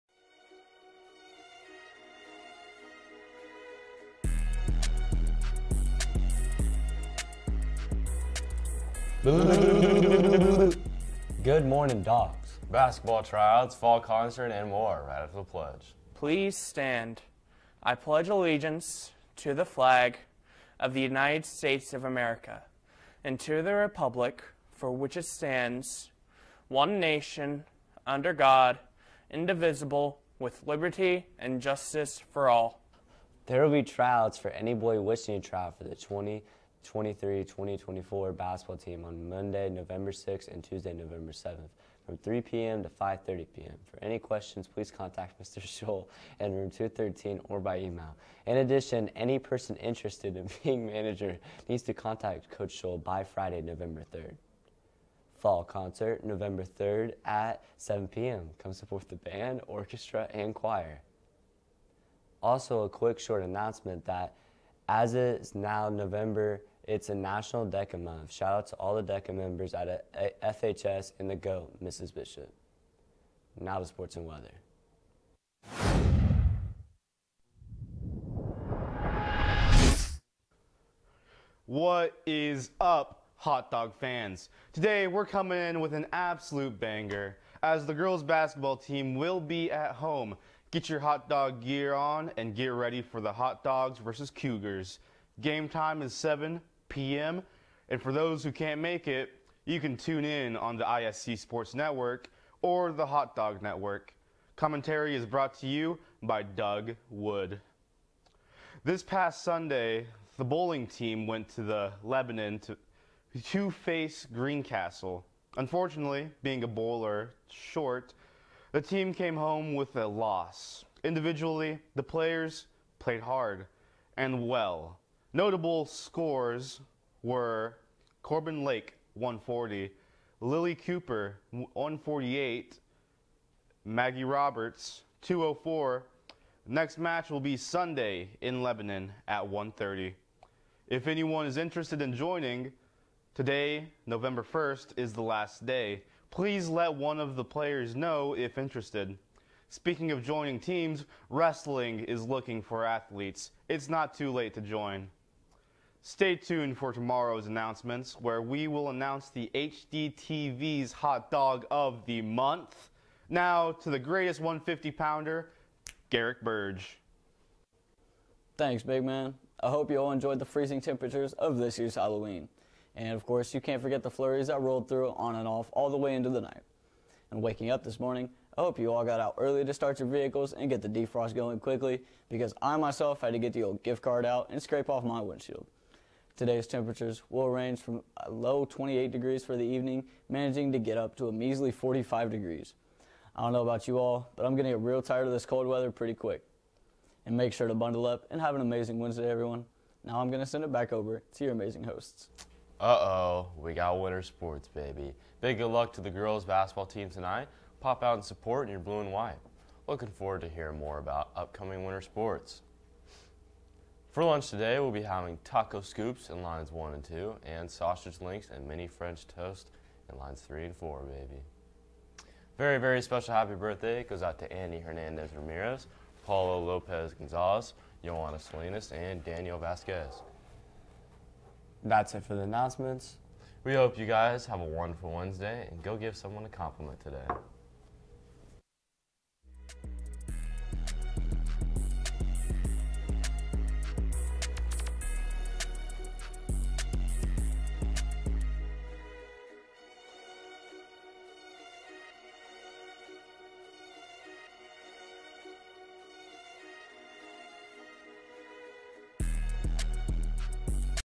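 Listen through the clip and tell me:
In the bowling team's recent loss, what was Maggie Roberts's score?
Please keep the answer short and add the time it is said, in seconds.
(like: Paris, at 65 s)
204, at 133 s.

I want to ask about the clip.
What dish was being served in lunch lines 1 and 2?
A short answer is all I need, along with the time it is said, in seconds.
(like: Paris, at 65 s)
Taco scoops, at 215 s.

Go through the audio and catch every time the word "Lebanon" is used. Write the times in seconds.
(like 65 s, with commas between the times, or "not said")
112 s, 138 s.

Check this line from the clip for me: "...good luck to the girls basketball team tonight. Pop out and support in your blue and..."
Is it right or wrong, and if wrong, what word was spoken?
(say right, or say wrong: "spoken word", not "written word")
right.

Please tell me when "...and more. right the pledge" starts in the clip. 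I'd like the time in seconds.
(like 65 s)
14 s.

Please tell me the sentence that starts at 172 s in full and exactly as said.
And of course, you can't forget the flurries I rolled through on and off all the way into the night.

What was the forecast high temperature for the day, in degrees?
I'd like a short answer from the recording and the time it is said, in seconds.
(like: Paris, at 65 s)
45, at 191 s.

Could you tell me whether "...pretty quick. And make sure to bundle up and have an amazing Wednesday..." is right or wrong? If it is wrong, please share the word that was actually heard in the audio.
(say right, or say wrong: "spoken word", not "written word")
right.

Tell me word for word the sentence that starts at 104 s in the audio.
Commentary is brought to you by Doug Wood.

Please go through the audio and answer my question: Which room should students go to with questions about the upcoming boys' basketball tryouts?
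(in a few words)
213.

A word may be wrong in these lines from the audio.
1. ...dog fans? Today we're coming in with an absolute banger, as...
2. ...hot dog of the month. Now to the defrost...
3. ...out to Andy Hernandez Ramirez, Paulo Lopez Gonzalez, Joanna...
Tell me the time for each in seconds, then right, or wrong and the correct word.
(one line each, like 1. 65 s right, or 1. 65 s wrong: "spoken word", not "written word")
1. 83 s right
2. 160 s wrong: "greatest", not "defrost"
3. 224 s right.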